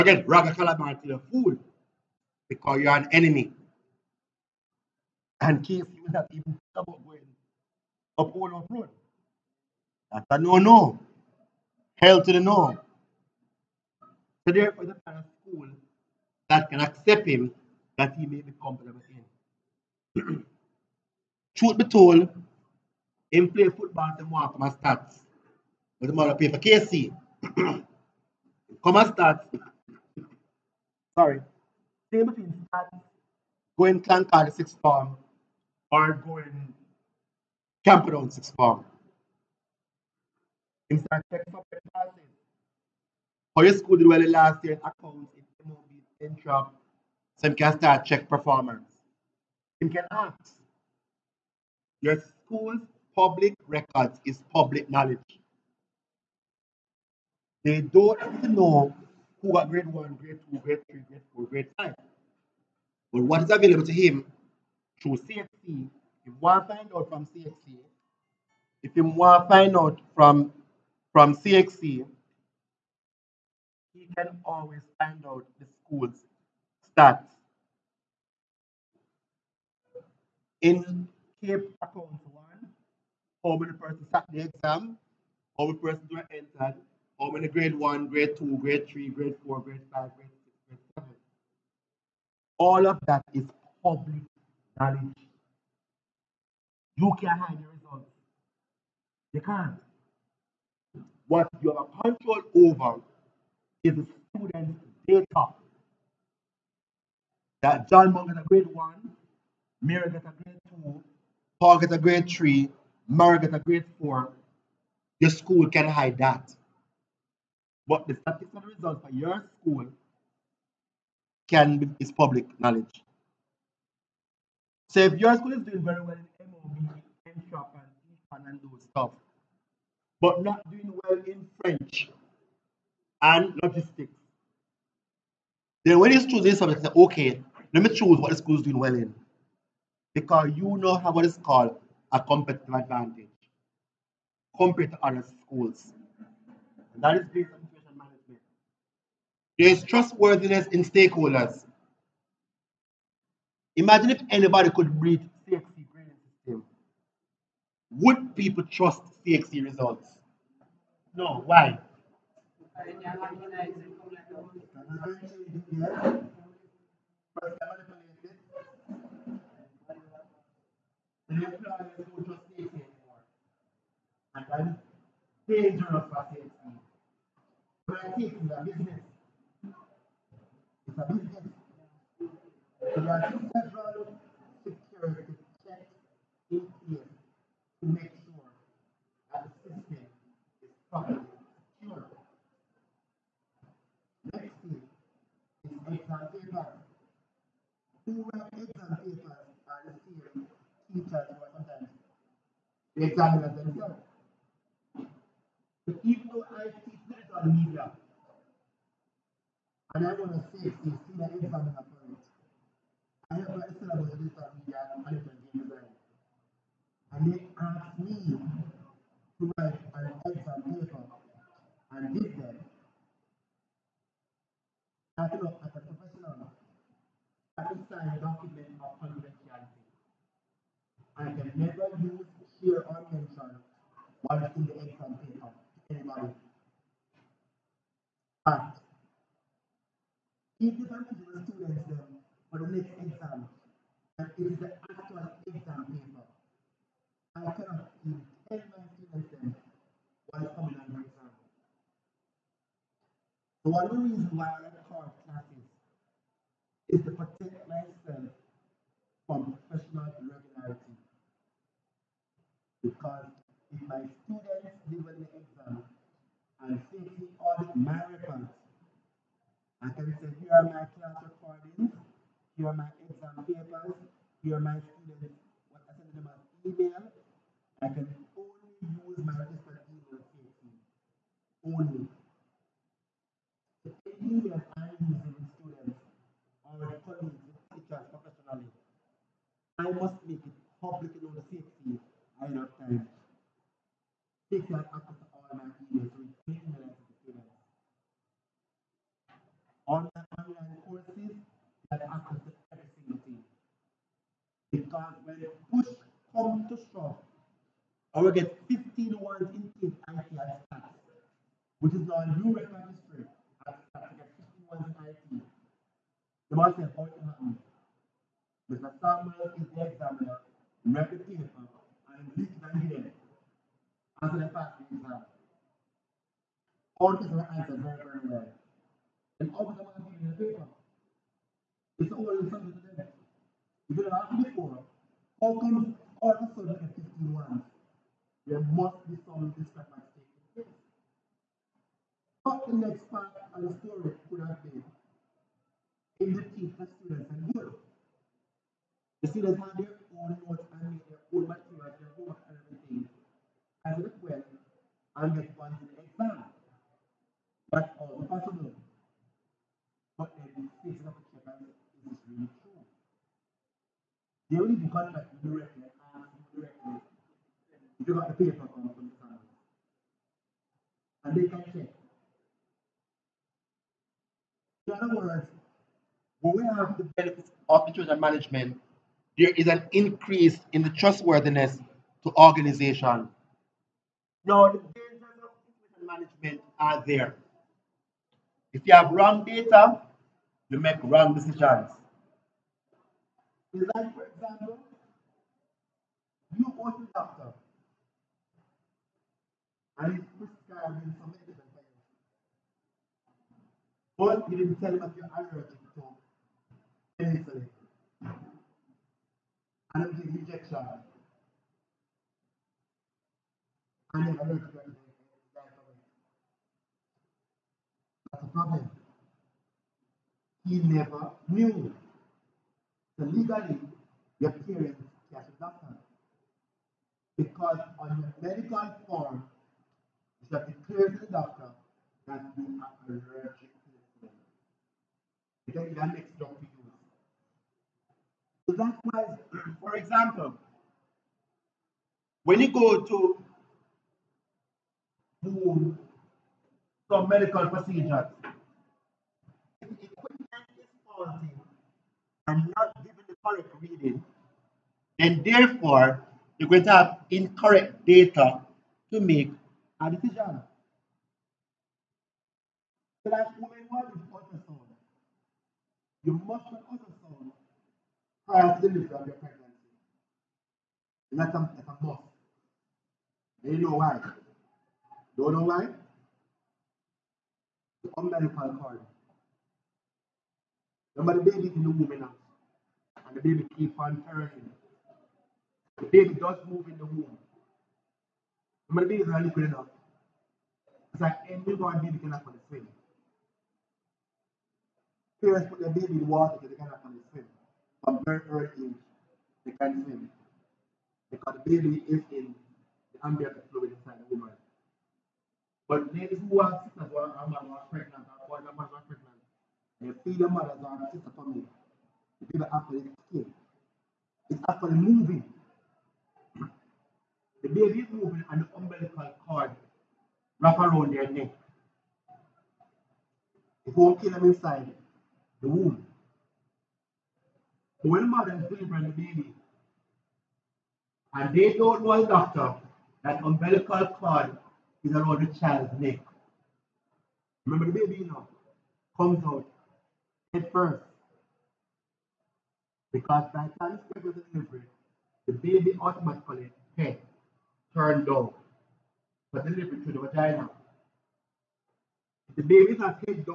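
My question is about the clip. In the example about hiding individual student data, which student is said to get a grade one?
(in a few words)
John Monk.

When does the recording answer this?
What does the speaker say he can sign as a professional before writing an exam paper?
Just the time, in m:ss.
3:48.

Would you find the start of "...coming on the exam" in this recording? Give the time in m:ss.
4:10.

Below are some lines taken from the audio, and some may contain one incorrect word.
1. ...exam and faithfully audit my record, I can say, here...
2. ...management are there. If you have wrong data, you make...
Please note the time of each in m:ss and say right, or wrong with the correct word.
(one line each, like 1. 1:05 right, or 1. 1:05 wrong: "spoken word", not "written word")
1. 4:25 right
2. 6:26 right.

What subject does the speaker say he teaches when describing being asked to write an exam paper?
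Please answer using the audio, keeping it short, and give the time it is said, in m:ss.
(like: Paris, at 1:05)
digital media, at 3:27.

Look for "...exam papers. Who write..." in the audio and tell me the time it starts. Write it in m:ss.
3:15.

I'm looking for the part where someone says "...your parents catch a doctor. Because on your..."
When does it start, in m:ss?
7:04.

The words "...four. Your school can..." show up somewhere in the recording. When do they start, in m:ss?
1:54.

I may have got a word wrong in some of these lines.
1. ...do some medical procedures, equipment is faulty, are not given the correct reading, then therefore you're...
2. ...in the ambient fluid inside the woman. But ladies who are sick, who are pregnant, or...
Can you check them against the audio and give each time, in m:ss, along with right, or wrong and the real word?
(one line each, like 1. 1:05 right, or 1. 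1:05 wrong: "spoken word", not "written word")
1. 7:25 right
2. 8:22 right.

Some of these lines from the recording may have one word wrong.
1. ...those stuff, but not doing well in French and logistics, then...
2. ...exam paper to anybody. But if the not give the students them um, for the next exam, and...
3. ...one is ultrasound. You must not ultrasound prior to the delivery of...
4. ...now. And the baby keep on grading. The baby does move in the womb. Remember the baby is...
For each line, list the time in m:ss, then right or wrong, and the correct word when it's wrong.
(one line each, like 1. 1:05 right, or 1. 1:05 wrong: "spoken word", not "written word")
1. 2:08 right
2. 3:54 right
3. 7:43 right
4. 8:02 wrong: "turning", not "grading".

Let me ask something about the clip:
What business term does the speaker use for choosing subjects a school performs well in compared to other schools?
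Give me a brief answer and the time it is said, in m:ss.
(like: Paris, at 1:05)
competitive advantage, at 2:22.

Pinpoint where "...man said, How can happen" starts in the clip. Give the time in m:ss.
5:16.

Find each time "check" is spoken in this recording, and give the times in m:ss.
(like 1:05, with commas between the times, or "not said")
0:41, 0:48, 3:05, 6:11.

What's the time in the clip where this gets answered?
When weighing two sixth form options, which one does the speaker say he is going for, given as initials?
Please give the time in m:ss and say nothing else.
0:26.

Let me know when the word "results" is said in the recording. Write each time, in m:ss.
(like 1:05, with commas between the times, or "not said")
1:37, 1:58, 2:39.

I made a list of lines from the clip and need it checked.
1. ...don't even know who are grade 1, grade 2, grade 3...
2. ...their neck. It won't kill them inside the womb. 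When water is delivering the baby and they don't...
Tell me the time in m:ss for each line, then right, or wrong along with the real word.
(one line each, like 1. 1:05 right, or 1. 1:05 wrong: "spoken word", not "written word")
1. 0:57 right
2. 8:41 wrong: "mother", not "water".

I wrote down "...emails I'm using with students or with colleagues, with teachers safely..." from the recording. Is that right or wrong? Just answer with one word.
wrong.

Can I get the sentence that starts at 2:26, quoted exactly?
And that is based on there is trustworthiness in stakeholders.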